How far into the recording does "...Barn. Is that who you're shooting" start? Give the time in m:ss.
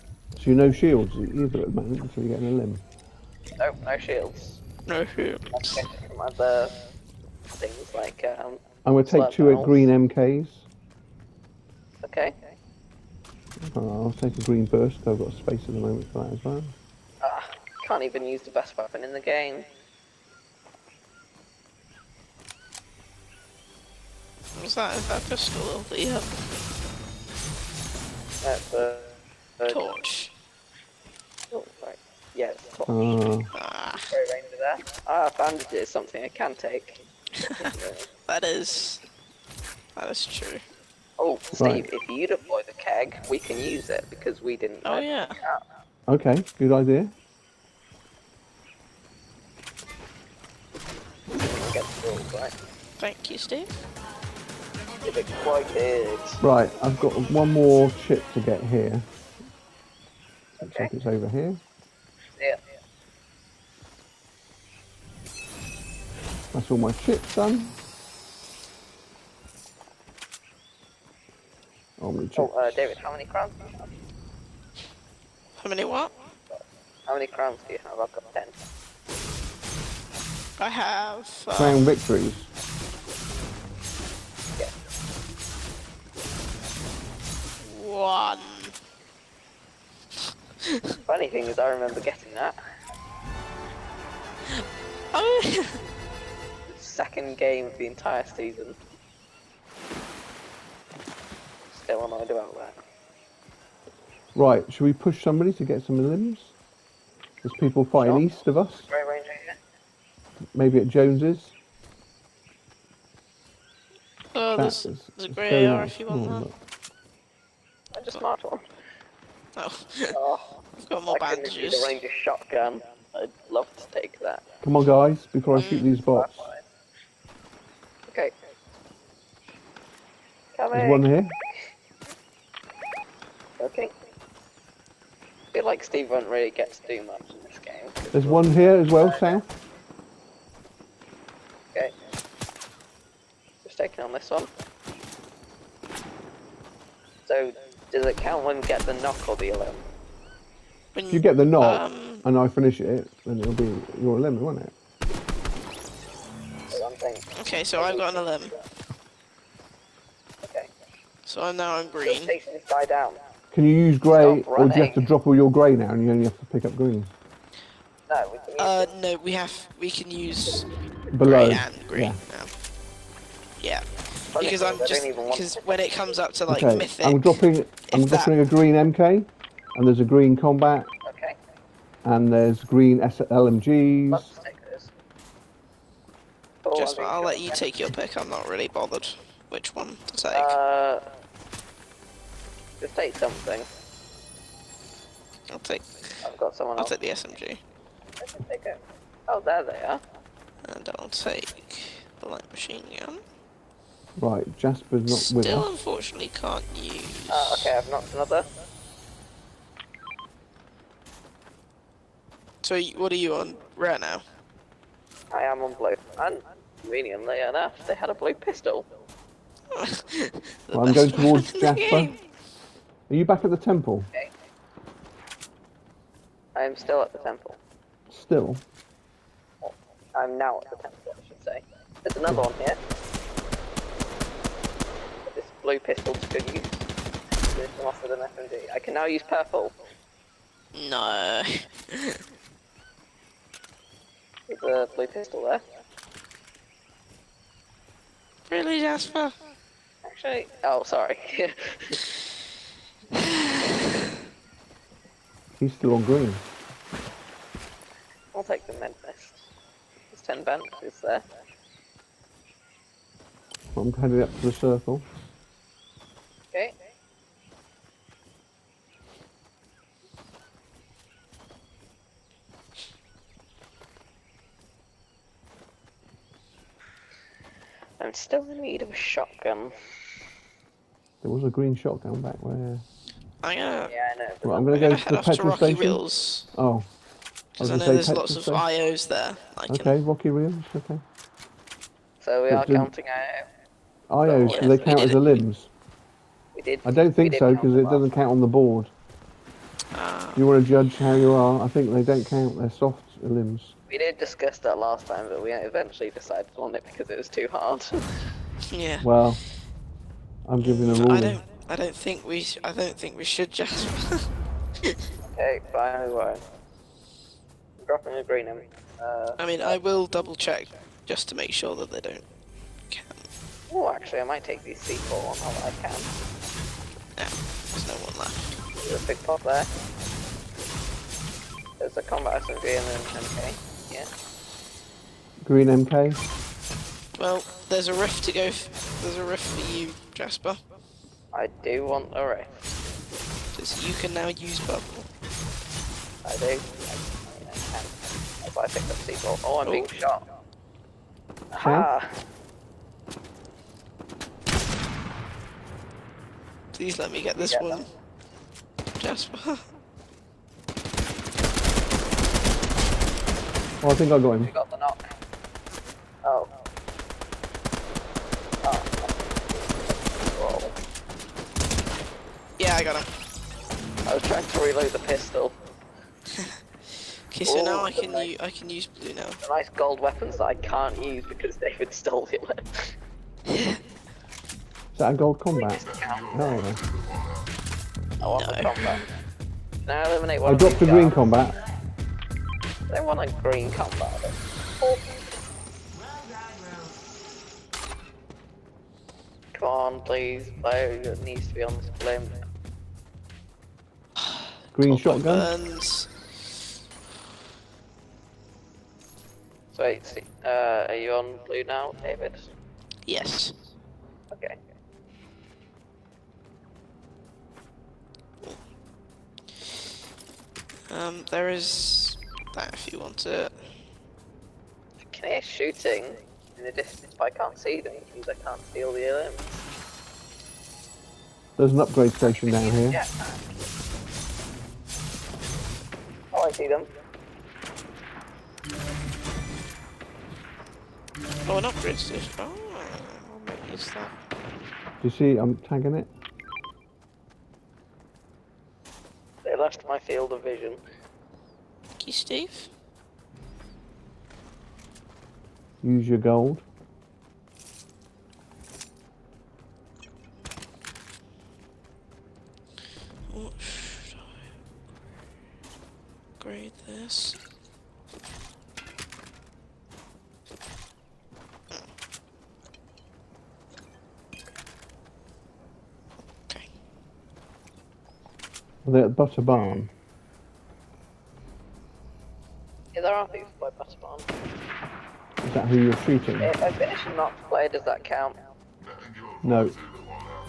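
8:04.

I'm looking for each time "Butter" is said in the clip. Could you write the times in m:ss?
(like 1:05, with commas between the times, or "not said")
7:59, 8:03.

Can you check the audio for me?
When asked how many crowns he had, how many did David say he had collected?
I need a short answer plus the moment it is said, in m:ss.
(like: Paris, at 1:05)
10, at 1:18.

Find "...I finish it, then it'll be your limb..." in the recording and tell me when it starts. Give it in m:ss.
2:32.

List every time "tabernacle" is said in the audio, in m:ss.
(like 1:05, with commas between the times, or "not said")
not said.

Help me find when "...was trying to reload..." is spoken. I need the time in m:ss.
6:14.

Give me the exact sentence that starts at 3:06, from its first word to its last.
Just, oh, I'll let you take your pick, I'm not really bothered which one to take.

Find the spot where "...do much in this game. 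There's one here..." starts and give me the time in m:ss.
2:16.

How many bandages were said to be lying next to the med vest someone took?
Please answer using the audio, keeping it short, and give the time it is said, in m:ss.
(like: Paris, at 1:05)
10, at 4:20.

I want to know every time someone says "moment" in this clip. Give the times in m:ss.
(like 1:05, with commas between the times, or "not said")
0:01, 0:15.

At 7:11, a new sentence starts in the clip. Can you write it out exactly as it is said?
There's an upgrade station down here.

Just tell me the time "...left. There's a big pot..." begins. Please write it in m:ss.
5:28.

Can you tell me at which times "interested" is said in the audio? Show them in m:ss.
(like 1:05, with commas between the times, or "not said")
not said.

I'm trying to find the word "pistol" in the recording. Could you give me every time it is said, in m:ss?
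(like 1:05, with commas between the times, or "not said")
0:25, 3:38, 3:55, 4:05, 6:14.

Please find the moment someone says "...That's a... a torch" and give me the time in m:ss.
0:28.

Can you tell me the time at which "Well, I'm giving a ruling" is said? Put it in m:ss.
5:09.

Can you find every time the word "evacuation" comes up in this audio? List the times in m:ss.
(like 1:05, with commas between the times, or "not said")
not said.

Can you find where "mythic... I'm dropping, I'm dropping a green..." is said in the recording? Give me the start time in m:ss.
2:56.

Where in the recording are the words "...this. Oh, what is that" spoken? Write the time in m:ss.
7:21.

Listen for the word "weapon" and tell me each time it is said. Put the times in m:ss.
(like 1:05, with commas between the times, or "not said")
0:18, 6:19.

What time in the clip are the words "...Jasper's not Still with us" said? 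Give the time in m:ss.
3:24.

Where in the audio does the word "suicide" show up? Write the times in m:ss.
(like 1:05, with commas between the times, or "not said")
not said.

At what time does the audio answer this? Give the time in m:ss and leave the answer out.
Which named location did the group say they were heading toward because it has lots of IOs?
4:49.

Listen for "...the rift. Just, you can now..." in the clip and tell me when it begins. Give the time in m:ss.
5:42.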